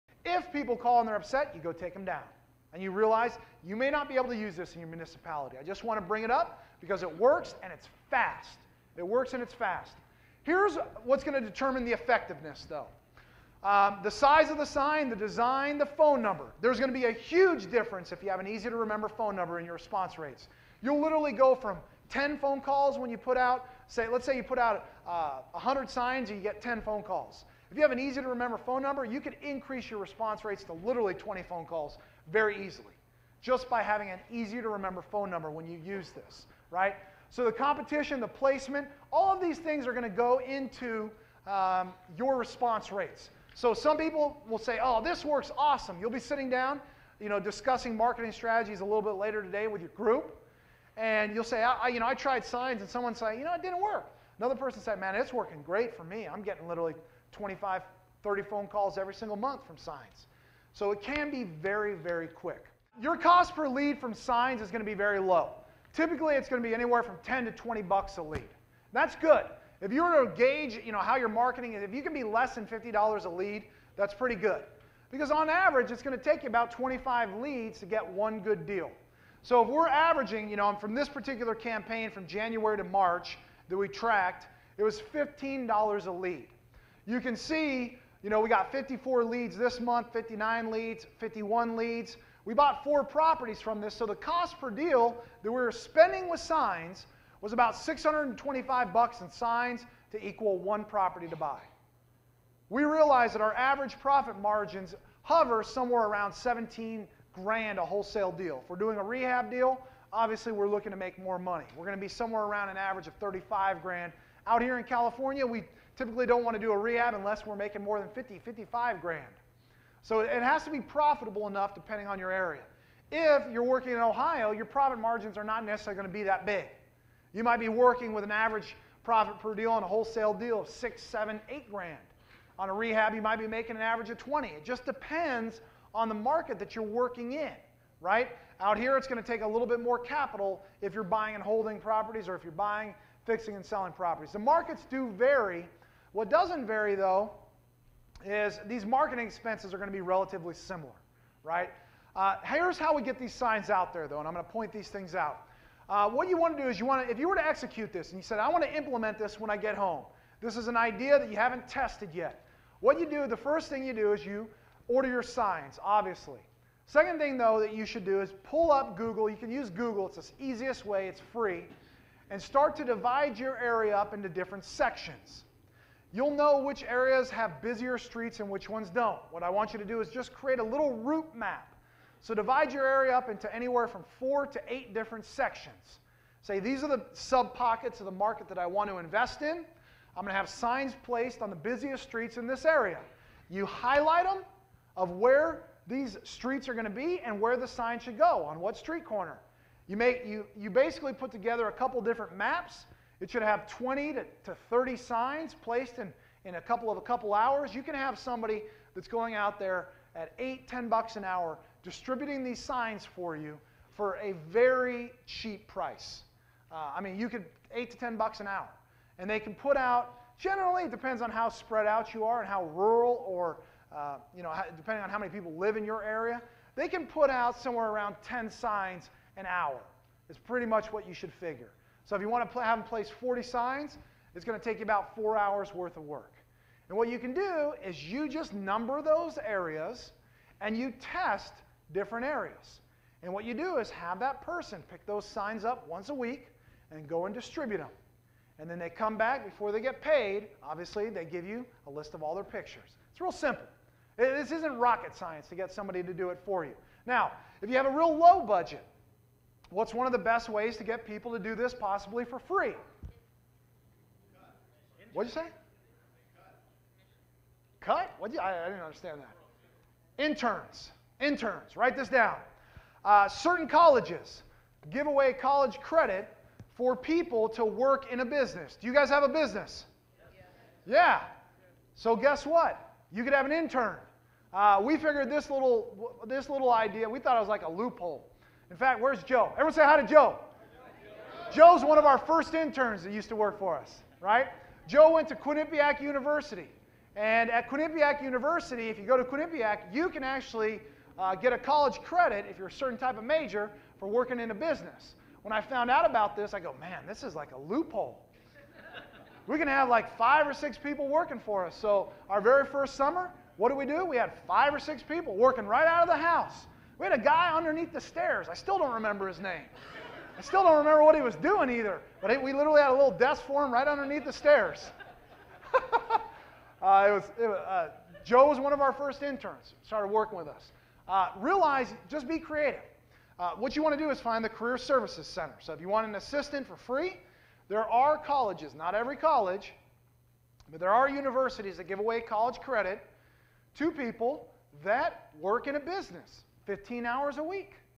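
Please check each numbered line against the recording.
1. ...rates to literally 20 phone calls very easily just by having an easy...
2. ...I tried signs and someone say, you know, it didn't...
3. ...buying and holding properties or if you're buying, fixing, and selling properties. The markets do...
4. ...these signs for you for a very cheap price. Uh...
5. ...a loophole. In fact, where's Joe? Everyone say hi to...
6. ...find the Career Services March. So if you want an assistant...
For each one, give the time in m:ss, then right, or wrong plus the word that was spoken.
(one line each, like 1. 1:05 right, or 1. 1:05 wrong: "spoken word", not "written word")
1. 0:30 right
2. 0:52 right
3. 2:21 right
4. 3:32 right
5. 4:47 right
6. 5:34 wrong: "Center", not "March".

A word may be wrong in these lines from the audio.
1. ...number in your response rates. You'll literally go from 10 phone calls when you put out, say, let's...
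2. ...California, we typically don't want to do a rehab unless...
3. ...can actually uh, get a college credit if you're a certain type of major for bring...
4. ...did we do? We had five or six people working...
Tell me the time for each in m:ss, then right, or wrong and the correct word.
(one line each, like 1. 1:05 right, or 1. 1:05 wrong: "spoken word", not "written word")
1. 0:19 right
2. 1:54 right
3. 5:00 wrong: "working", not "bring"
4. 5:13 right.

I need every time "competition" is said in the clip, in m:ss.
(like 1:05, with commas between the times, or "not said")
0:37.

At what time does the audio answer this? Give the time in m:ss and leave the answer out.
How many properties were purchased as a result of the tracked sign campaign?
1:32.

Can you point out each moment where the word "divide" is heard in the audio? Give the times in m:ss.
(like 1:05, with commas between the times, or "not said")
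2:52, 3:02.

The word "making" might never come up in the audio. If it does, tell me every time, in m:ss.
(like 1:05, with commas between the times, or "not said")
1:57, 2:13.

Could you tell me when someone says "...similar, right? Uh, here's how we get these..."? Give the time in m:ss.
2:30.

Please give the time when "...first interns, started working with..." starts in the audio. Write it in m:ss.
5:28.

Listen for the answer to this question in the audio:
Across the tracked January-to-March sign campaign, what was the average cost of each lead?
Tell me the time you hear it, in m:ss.
1:25.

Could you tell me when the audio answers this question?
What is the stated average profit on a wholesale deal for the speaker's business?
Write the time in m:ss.
1:46.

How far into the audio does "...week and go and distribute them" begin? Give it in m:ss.
4:06.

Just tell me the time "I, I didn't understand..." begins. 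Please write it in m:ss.
4:28.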